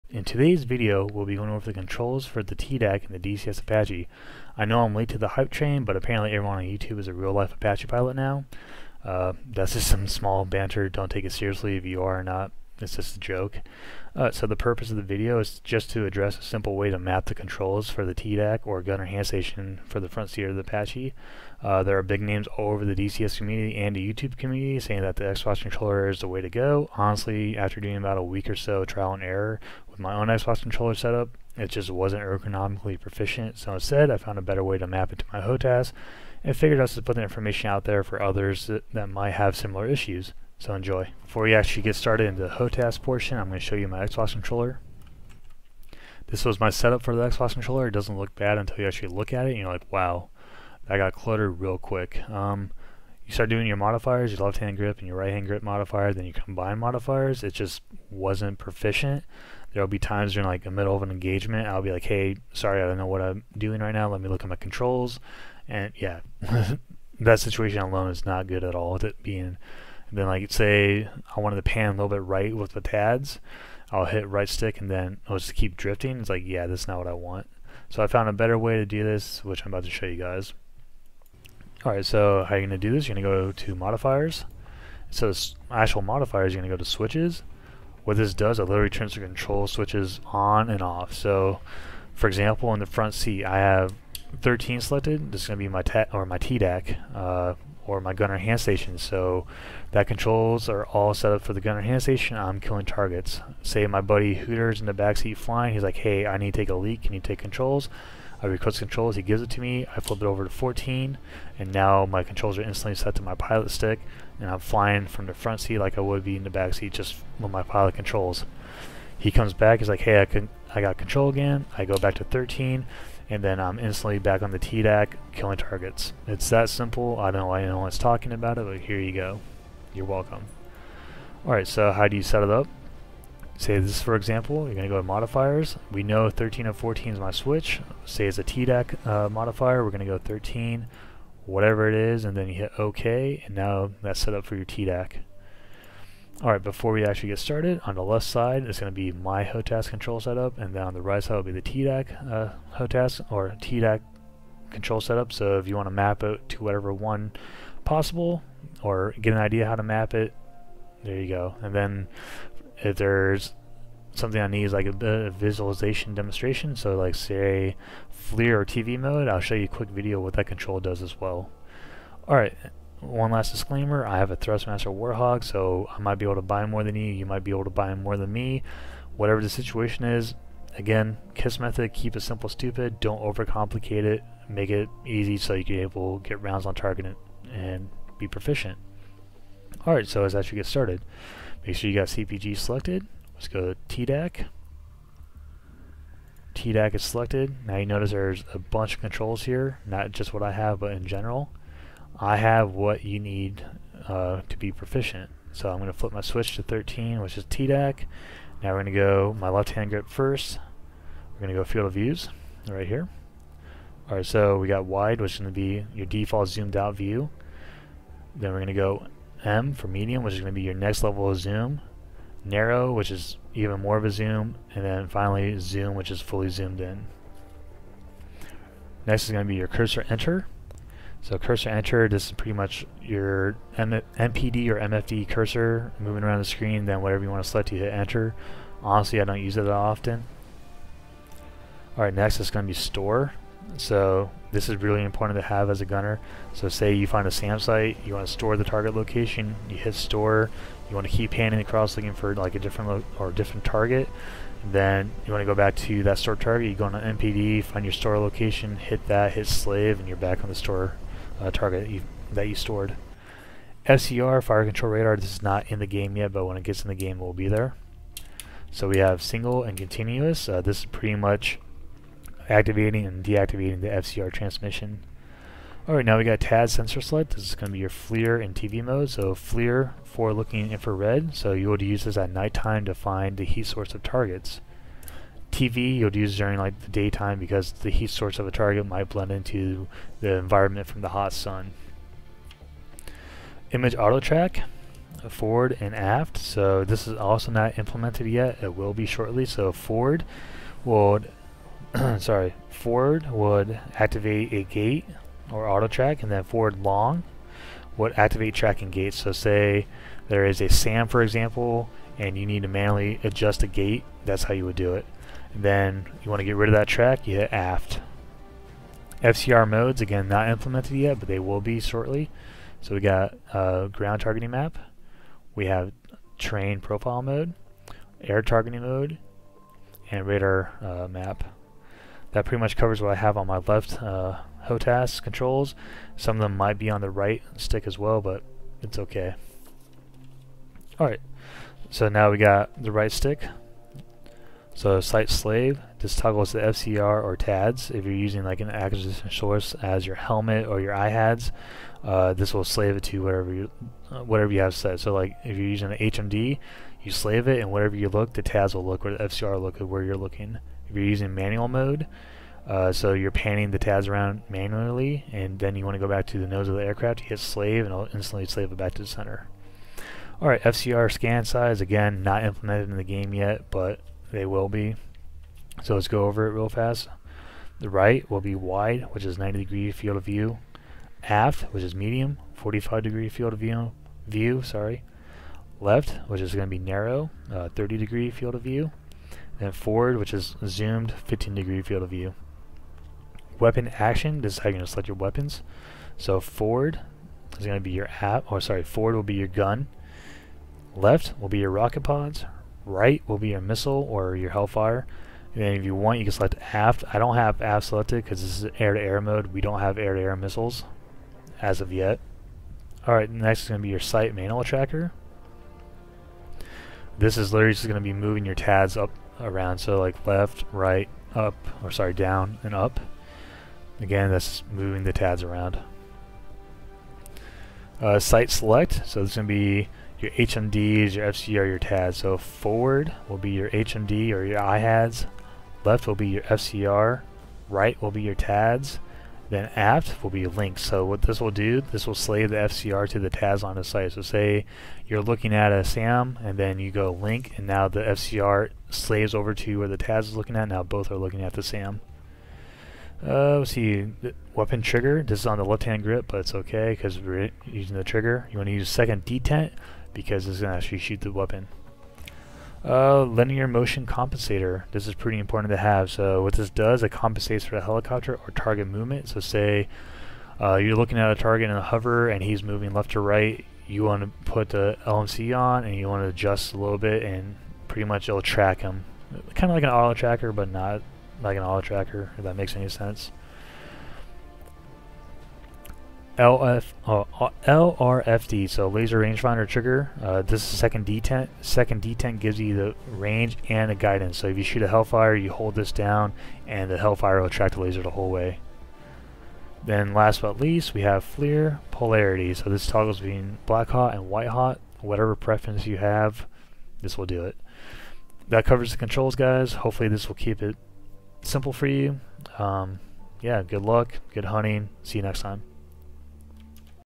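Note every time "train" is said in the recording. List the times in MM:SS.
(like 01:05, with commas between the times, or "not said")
00:05, 05:26.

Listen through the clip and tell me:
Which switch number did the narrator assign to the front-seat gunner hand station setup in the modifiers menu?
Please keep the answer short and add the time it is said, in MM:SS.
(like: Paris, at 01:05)
13, at 01:33.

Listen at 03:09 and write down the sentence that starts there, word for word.
Alright, so let's actually get started.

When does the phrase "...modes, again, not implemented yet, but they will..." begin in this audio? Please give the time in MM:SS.
05:19.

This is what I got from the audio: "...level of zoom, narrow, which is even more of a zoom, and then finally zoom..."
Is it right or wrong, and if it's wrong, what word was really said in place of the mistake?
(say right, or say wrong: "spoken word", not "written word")
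right.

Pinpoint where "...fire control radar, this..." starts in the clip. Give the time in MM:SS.
04:24.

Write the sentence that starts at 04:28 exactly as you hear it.
So we have single and continuous.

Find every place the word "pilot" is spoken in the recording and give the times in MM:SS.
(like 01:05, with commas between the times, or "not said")
00:07, 01:53, 01:57.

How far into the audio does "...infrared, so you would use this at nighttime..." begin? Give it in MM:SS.
04:40.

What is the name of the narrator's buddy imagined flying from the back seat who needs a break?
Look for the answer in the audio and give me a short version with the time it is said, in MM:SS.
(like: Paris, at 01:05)
Hooter, at 01:44.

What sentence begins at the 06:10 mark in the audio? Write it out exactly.
Alright, FCR scan size, again, not implemented in the game yet, but they will be.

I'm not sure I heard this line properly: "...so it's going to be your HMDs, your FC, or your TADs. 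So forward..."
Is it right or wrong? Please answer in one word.
right.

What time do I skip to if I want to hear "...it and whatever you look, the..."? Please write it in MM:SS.
05:57.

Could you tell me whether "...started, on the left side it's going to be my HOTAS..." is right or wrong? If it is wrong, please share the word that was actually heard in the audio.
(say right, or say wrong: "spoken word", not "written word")
right.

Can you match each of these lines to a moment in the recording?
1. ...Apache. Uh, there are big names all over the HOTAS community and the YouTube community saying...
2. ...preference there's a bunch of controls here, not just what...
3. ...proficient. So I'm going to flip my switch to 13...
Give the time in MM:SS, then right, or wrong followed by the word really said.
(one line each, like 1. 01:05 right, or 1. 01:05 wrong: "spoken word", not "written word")
1. 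00:20 wrong: "DCS", not "HOTAS"
2. 03:17 wrong: "notice", not "preference"
3. 03:24 right.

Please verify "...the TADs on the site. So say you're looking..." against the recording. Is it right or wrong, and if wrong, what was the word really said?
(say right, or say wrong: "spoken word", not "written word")
right.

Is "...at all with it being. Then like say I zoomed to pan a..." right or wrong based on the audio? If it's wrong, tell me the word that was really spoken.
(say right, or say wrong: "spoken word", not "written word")
wrong: "wanted", not "zoomed".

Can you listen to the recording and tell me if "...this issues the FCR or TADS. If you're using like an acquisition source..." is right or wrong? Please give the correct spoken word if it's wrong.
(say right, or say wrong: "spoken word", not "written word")
wrong: "toggles", not "issues".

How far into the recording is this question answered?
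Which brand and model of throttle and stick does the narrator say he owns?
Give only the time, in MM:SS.
02:54.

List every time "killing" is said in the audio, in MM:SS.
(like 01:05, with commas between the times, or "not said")
01:42, 02:05.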